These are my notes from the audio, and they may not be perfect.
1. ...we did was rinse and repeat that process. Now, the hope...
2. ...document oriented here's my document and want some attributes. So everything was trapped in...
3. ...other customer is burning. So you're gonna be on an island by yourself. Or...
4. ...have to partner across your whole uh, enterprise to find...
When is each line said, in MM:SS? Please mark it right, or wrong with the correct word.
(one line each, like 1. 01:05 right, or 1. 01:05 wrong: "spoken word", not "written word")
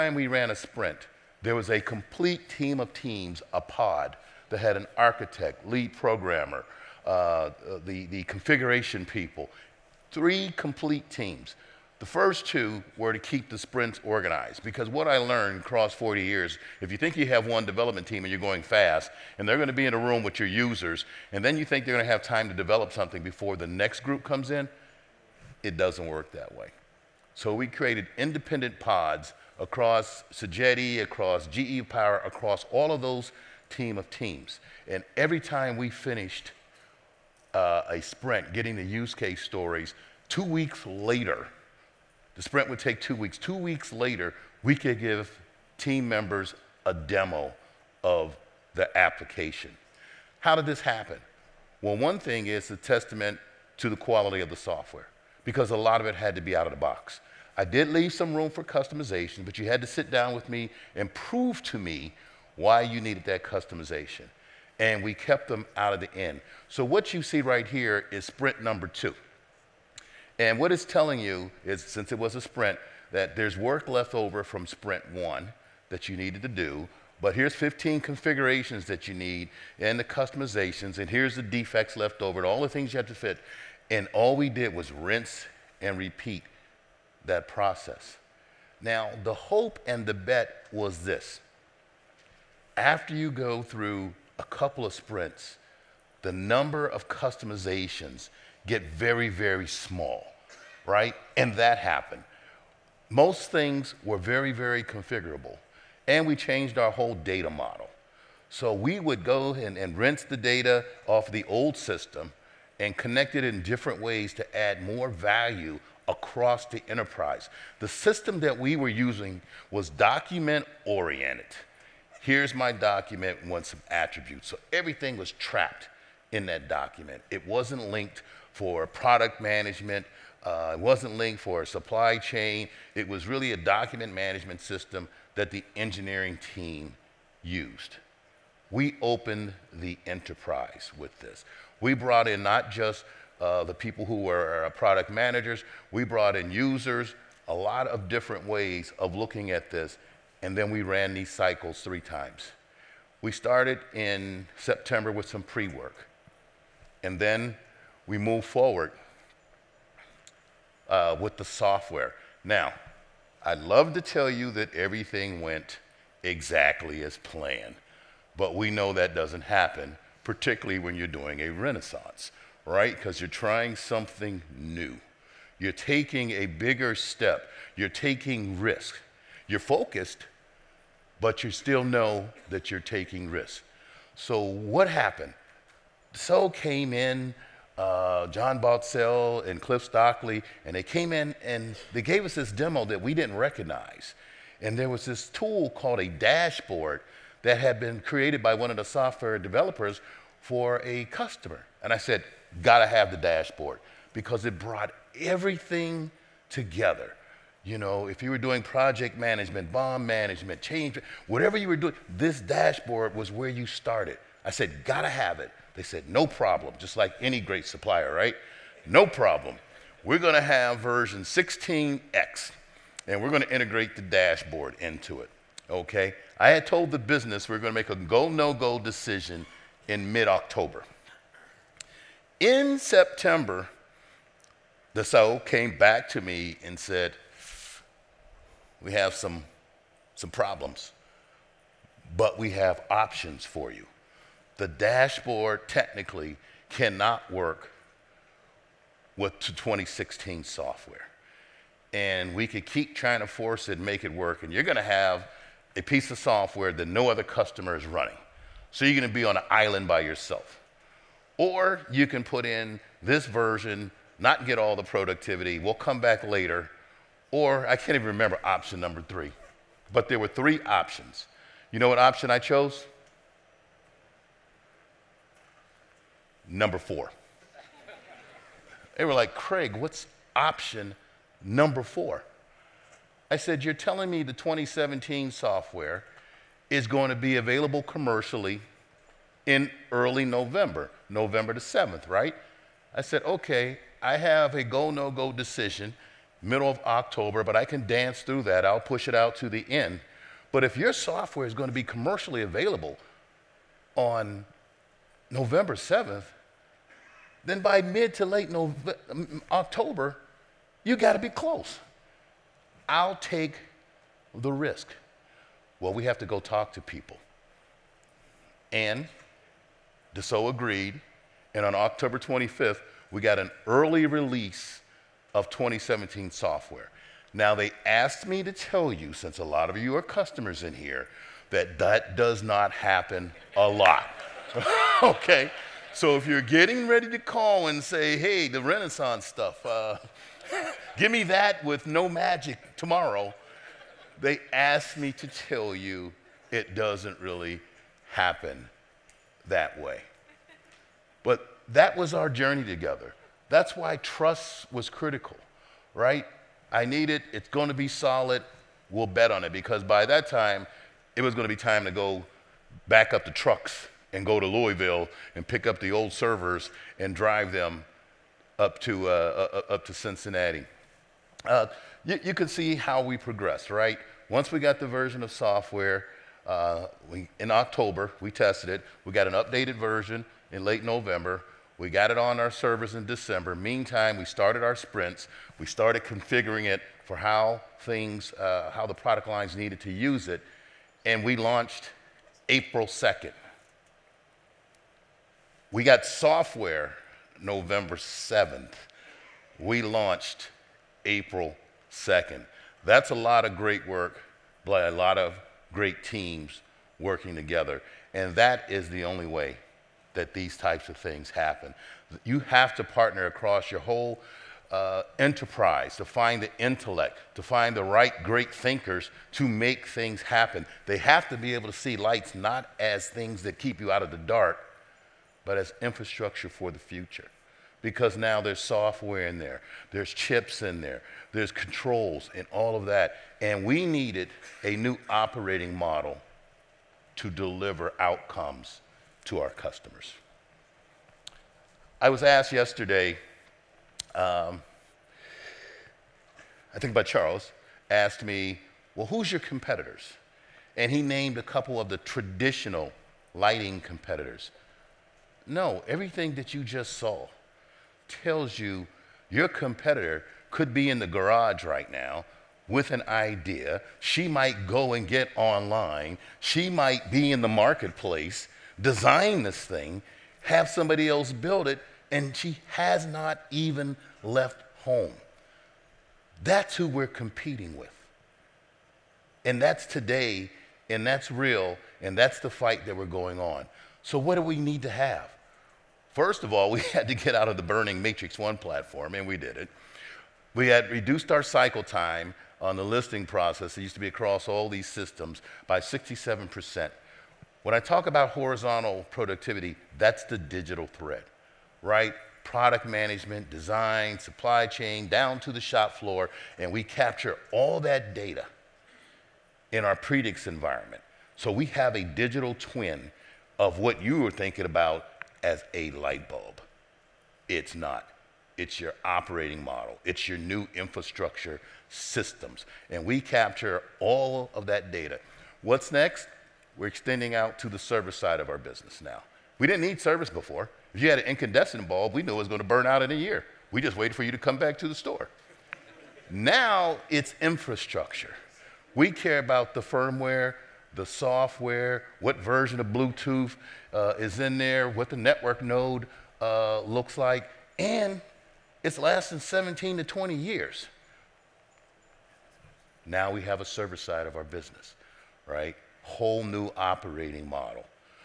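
1. 01:24 right
2. 01:59 right
3. 04:17 wrong: "running", not "burning"
4. 06:52 right.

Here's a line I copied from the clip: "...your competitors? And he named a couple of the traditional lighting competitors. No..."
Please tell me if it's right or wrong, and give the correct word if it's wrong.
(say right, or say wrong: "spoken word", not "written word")
right.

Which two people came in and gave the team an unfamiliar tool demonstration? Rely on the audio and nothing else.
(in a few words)
John Baltzell and Cliff Stockley.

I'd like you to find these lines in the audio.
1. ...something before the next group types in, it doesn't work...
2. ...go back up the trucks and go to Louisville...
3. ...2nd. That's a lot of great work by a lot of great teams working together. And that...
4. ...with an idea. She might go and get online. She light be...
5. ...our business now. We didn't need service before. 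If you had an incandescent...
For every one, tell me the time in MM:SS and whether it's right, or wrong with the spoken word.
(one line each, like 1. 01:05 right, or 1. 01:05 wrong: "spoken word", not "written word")
1. 00:22 wrong: "comes", not "types"
2. 06:01 right
3. 06:41 right
4. 07:42 wrong: "might", not "light"
5. 08:48 right.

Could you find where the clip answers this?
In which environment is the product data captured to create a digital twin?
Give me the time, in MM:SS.
08:29.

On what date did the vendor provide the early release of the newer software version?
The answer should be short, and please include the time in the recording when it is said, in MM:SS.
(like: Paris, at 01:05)
October 25, at 05:21.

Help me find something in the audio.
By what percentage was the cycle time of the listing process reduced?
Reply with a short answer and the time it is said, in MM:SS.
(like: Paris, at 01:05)
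67%, at 08:15.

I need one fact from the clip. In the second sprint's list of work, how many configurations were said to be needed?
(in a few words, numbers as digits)
15.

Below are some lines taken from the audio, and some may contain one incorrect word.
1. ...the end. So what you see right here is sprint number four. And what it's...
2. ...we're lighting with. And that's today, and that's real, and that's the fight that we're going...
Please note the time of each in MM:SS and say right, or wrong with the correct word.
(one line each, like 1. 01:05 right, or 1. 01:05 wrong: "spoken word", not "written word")
1. 01:05 wrong: "two", not "four"
2. 07:56 wrong: "competing", not "lighting".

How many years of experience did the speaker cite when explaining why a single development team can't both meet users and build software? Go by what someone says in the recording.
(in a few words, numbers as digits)
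40 years.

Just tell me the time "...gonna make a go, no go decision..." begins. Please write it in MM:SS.
03:47.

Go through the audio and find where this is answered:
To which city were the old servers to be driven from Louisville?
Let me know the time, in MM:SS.
06:09.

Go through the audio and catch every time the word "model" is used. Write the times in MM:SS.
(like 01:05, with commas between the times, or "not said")
01:47, 07:15, 08:39, 09:17.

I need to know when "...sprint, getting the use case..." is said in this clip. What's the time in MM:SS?
00:38.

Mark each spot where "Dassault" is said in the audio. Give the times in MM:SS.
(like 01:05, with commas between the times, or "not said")
03:54, 05:20.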